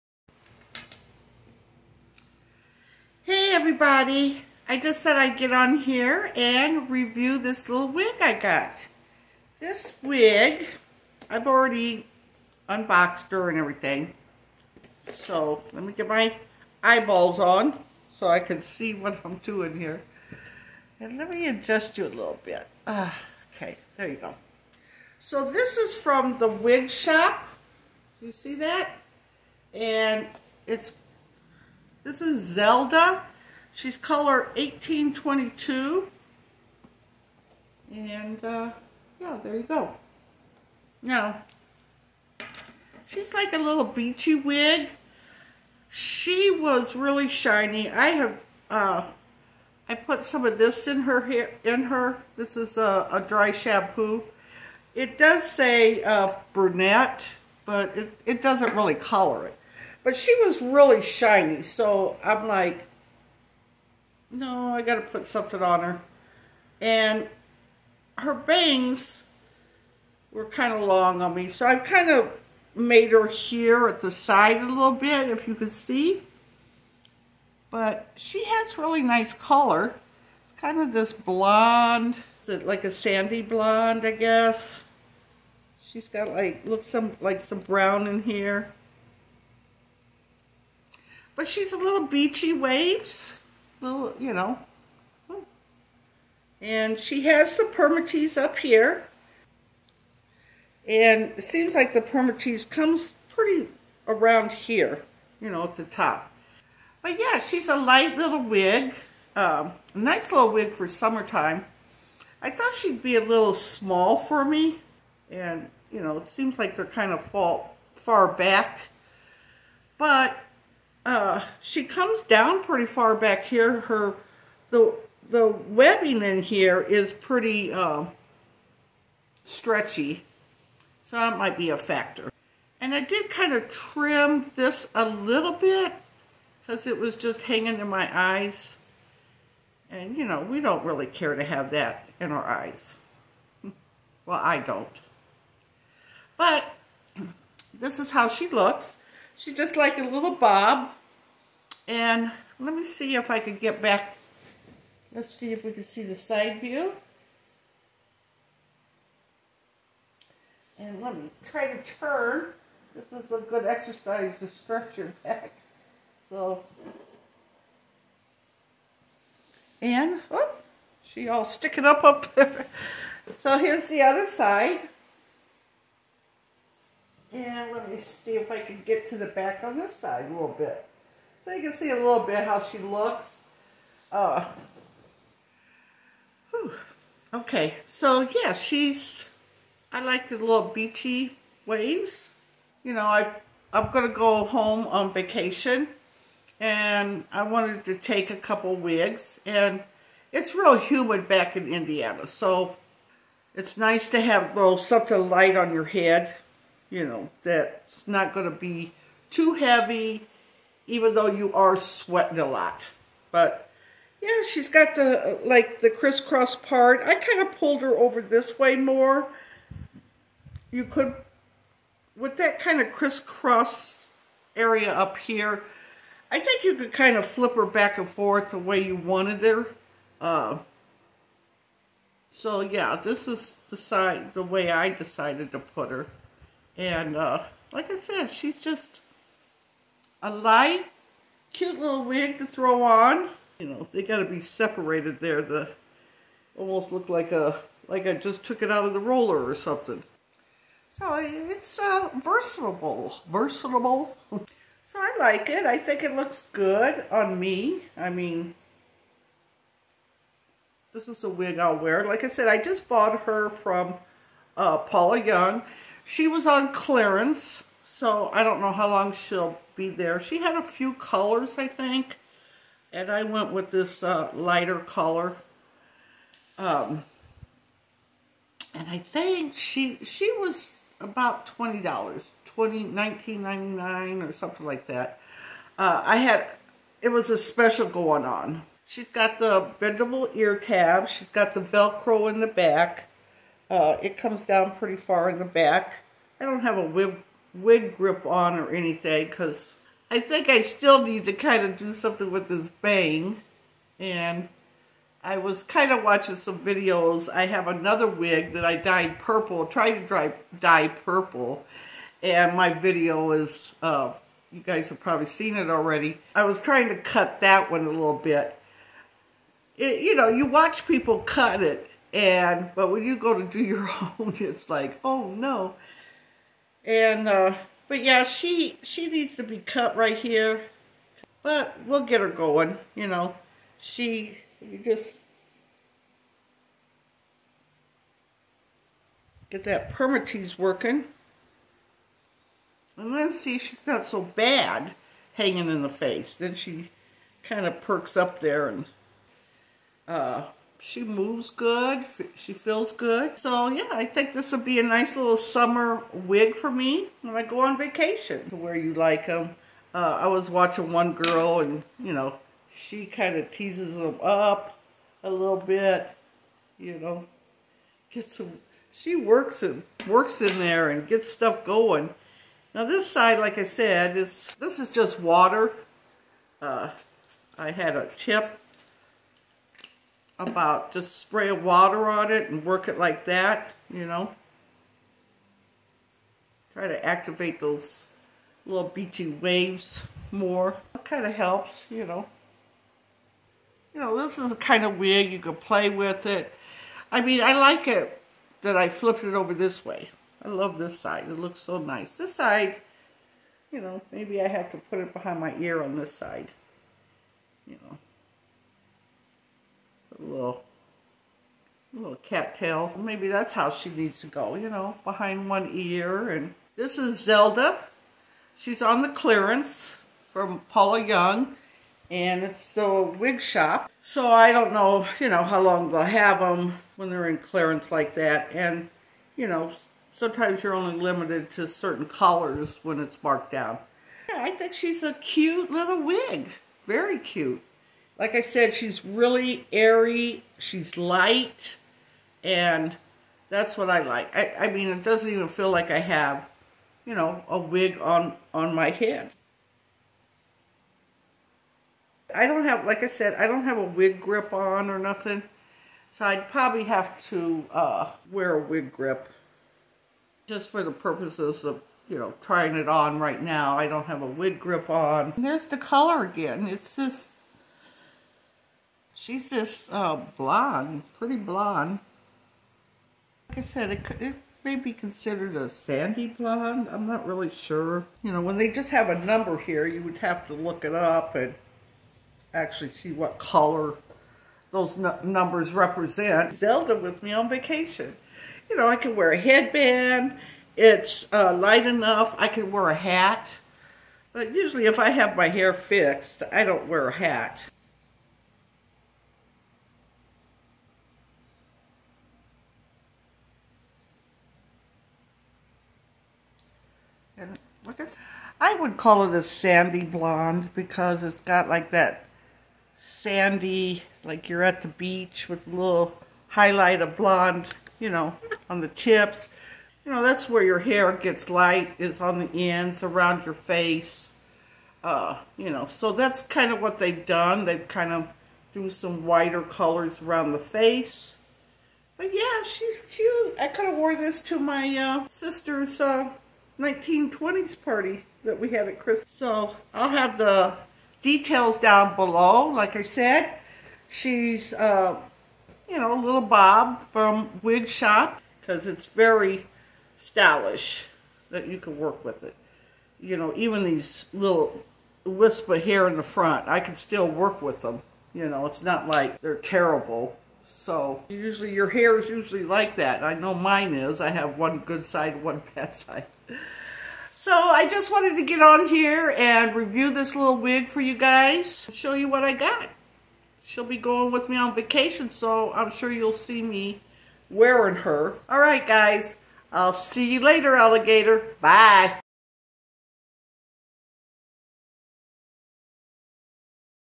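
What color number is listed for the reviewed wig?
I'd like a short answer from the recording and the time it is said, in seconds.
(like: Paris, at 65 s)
1822, at 34 s.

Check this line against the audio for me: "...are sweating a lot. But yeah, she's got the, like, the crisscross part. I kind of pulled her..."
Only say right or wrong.
right.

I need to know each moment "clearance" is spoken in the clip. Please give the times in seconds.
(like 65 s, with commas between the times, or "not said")
266 s, 419 s, 427 s.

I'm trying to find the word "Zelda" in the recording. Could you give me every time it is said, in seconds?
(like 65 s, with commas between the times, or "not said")
32 s, 417 s, 486 s.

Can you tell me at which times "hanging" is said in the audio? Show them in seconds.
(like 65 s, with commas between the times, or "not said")
137 s, 345 s.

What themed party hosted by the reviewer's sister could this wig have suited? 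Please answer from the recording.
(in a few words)
1920s party.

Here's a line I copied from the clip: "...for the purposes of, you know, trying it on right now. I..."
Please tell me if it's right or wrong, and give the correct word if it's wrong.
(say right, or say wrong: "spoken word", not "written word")
right.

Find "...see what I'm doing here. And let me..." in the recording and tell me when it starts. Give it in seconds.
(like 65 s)
18 s.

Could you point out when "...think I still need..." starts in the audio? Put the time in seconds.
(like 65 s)
300 s.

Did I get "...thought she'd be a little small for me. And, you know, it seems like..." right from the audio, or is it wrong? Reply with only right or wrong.
right.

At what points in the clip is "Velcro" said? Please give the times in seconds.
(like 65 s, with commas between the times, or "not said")
291 s.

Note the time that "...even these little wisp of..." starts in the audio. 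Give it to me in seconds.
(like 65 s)
553 s.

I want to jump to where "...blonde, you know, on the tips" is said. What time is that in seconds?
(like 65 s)
517 s.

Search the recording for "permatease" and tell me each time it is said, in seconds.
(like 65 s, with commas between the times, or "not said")
97 s, 102 s, 339 s.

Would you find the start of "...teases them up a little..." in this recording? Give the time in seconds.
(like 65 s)
363 s.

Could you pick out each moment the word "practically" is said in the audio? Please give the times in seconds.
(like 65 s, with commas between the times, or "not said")
not said.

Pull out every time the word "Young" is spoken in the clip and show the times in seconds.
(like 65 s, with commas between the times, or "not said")
265 s, 421 s.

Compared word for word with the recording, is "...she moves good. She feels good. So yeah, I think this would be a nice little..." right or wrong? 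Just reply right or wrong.
right.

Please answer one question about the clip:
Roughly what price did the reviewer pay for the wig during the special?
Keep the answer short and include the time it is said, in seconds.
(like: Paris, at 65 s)
$19.99, at 282 s.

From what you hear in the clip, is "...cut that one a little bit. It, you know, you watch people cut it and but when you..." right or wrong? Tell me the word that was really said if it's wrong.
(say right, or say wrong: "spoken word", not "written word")
right.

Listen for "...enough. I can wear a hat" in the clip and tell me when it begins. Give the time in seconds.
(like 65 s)
491 s.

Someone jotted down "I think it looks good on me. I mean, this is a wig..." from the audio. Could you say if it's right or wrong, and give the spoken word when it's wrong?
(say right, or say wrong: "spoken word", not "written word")
right.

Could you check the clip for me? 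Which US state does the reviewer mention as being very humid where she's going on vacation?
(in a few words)
Indiana.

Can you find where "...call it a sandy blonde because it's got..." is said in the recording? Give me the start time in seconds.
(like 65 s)
508 s.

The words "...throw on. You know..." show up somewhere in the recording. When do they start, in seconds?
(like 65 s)
242 s.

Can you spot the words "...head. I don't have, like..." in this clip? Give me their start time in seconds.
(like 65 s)
448 s.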